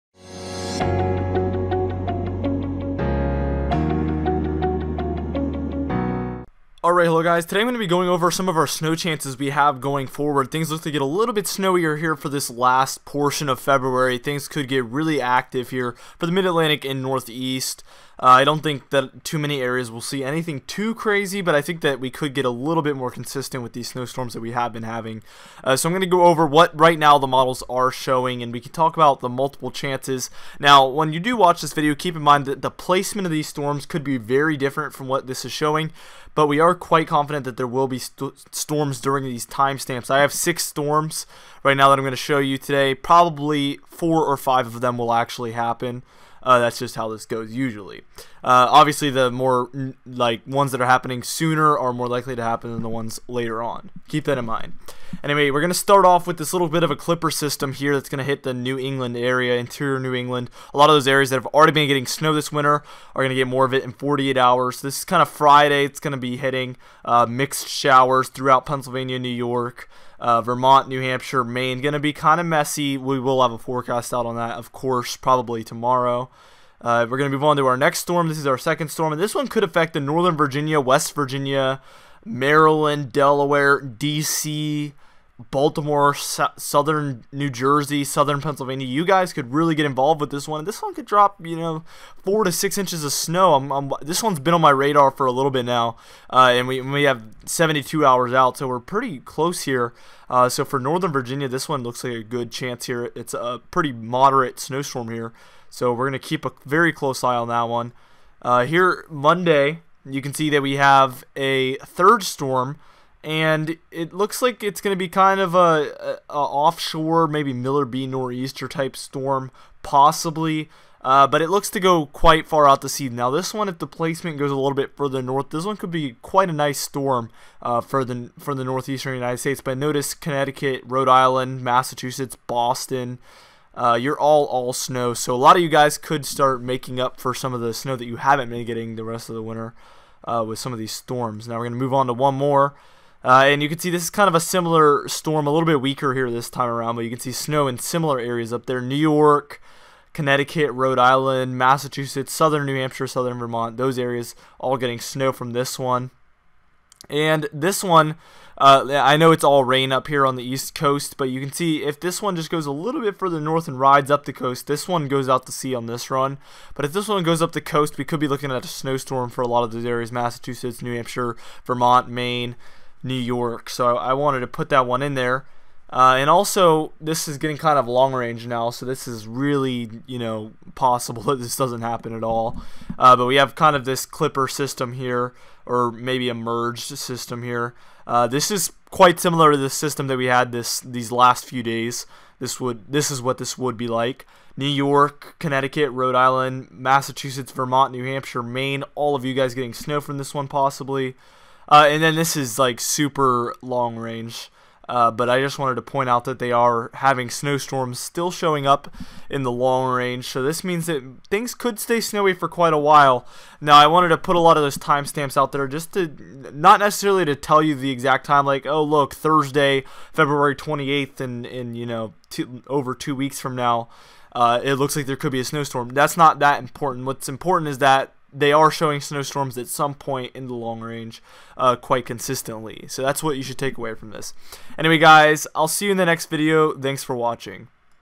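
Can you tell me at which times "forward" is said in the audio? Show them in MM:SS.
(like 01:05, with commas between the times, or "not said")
00:10.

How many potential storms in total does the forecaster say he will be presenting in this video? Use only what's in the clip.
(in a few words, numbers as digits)
6.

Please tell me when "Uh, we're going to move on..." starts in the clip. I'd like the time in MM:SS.
01:16.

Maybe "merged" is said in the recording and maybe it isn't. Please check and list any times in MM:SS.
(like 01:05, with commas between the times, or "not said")
03:06.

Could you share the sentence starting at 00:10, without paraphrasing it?
Things look to get a little bit snowier here for this last portion of February.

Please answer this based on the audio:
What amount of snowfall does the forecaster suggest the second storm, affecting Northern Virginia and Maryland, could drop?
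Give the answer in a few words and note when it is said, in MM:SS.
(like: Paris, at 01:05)
4 to 6 inches, at 01:32.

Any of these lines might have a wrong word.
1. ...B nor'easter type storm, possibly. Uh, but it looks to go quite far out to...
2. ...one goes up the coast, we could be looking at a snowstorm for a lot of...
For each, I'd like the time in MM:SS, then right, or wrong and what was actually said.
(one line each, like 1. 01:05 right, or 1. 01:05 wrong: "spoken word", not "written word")
1. 01:57 right
2. 02:47 right.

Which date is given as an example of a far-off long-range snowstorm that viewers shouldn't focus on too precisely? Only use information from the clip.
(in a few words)
Thursday, February 28th.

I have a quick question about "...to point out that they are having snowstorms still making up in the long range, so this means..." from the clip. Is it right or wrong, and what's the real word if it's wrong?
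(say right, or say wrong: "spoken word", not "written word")
wrong: "showing", not "making".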